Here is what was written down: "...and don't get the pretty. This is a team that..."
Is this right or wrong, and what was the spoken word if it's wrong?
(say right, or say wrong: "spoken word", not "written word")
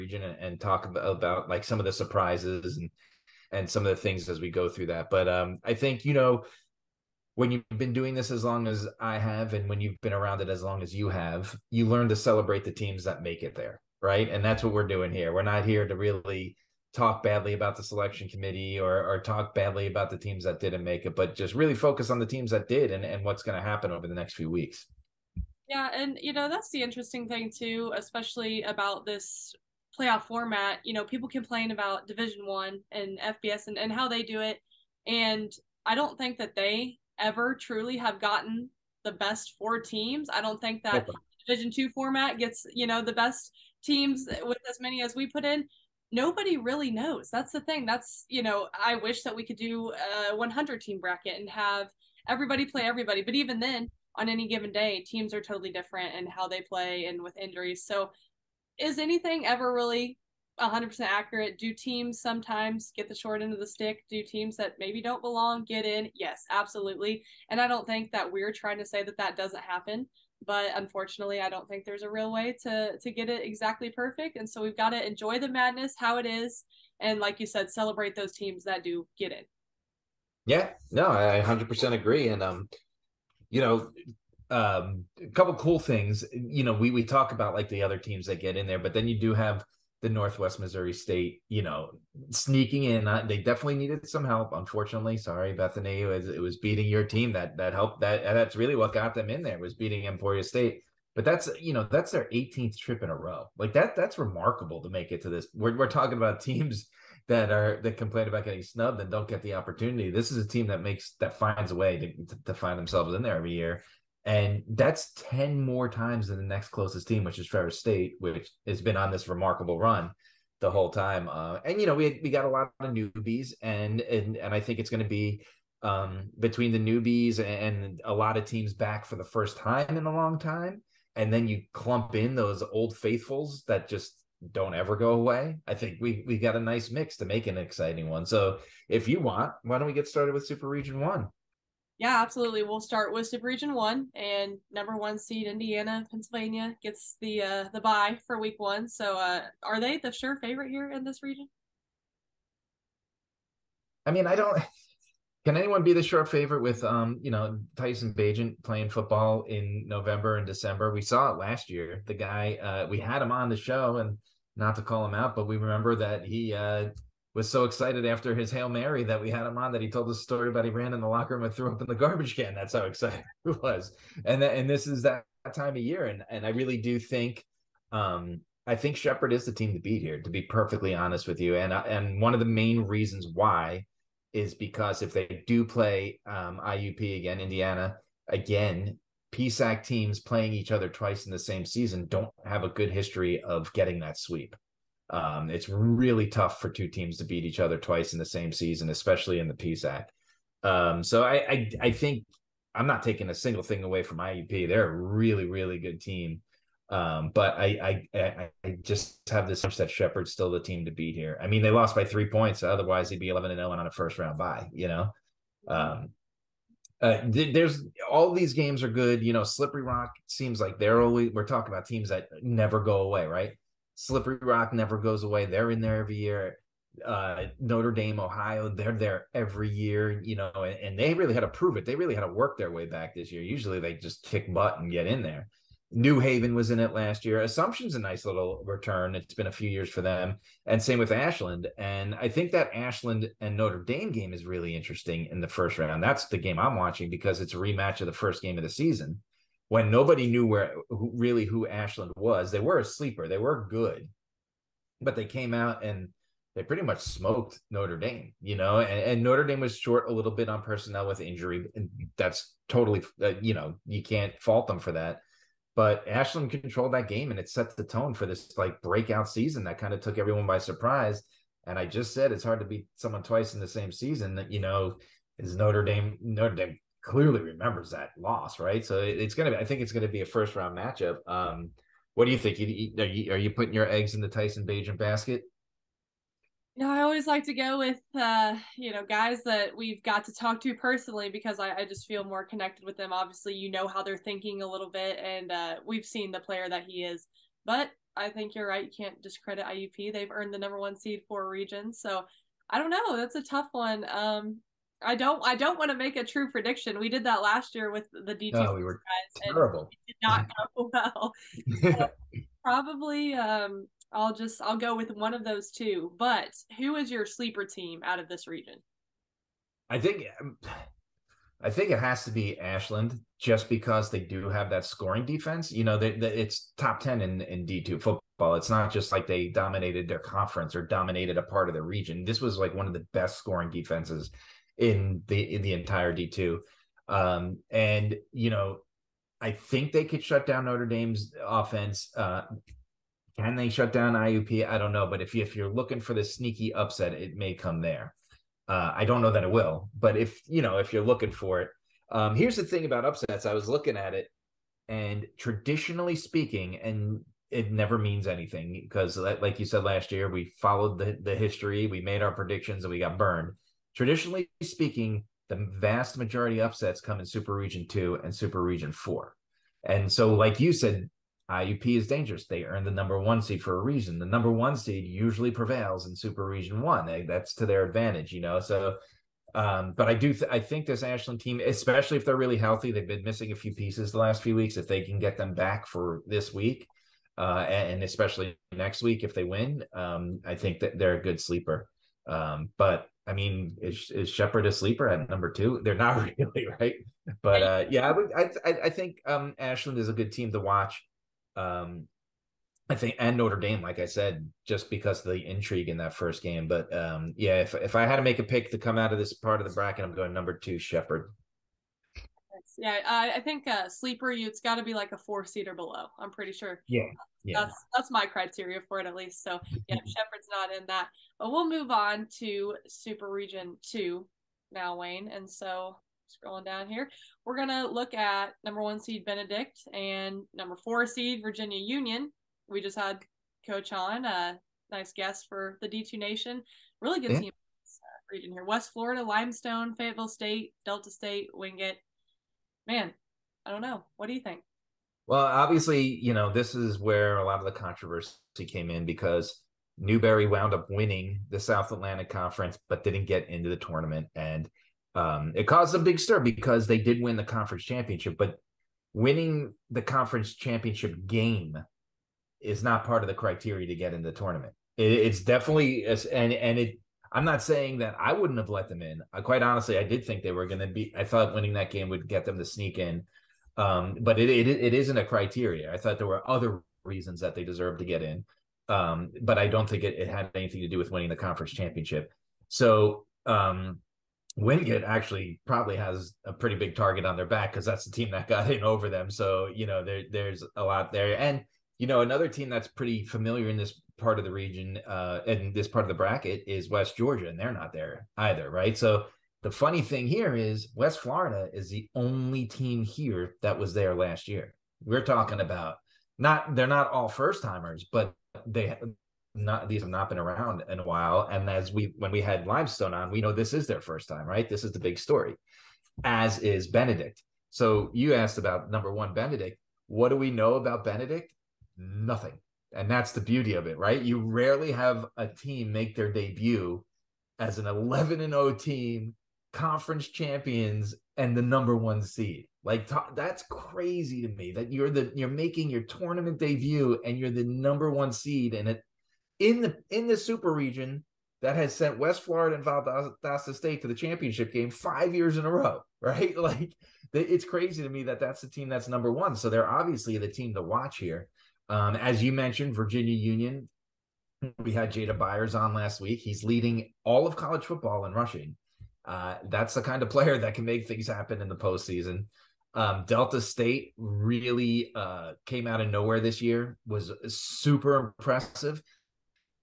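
wrong: "opportunity", not "pretty".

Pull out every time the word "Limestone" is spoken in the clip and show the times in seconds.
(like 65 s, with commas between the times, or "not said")
439 s, 512 s.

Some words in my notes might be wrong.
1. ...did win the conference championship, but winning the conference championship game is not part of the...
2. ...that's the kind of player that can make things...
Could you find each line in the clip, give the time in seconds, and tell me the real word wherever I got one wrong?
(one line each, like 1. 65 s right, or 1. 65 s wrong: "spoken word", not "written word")
1. 456 s right
2. 559 s right.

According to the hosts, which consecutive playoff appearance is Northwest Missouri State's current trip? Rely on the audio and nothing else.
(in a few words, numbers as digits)
18th.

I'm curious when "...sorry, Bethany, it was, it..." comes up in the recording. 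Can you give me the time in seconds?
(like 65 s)
95 s.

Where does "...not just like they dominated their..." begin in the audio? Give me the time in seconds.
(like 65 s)
328 s.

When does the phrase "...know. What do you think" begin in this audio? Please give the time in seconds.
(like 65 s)
443 s.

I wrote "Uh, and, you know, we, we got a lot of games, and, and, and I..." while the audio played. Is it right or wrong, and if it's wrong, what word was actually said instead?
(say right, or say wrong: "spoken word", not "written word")
wrong: "newbies", not "games".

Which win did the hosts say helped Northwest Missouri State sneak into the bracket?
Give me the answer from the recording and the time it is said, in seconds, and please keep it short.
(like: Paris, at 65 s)
Emporia State, at 100 s.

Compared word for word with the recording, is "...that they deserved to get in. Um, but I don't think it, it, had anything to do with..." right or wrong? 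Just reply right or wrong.
right.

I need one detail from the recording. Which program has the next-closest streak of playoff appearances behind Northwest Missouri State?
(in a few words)
Ferris State.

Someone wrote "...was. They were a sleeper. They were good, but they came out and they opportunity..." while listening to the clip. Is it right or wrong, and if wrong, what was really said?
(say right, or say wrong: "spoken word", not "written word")
wrong: "pretty", not "opportunity".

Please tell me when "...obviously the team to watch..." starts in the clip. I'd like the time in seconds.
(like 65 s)
549 s.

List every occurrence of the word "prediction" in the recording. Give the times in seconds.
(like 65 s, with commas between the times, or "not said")
306 s, 362 s.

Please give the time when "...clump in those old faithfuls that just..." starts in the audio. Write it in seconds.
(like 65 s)
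131 s.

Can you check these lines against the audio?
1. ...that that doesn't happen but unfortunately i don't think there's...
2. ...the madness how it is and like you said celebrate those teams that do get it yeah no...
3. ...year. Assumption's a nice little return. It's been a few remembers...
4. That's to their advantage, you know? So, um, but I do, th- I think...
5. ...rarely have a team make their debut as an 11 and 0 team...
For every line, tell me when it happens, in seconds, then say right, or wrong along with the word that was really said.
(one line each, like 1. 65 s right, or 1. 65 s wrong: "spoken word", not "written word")
1. 69 s right
2. 75 s right
3. 237 s wrong: "years", not "remembers"
4. 377 s right
5. 524 s right.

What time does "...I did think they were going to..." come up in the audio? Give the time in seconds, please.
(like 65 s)
469 s.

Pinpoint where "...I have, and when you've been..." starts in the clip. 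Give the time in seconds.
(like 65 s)
8 s.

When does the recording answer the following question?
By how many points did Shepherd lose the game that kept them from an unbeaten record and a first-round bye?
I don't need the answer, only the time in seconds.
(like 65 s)
212 s.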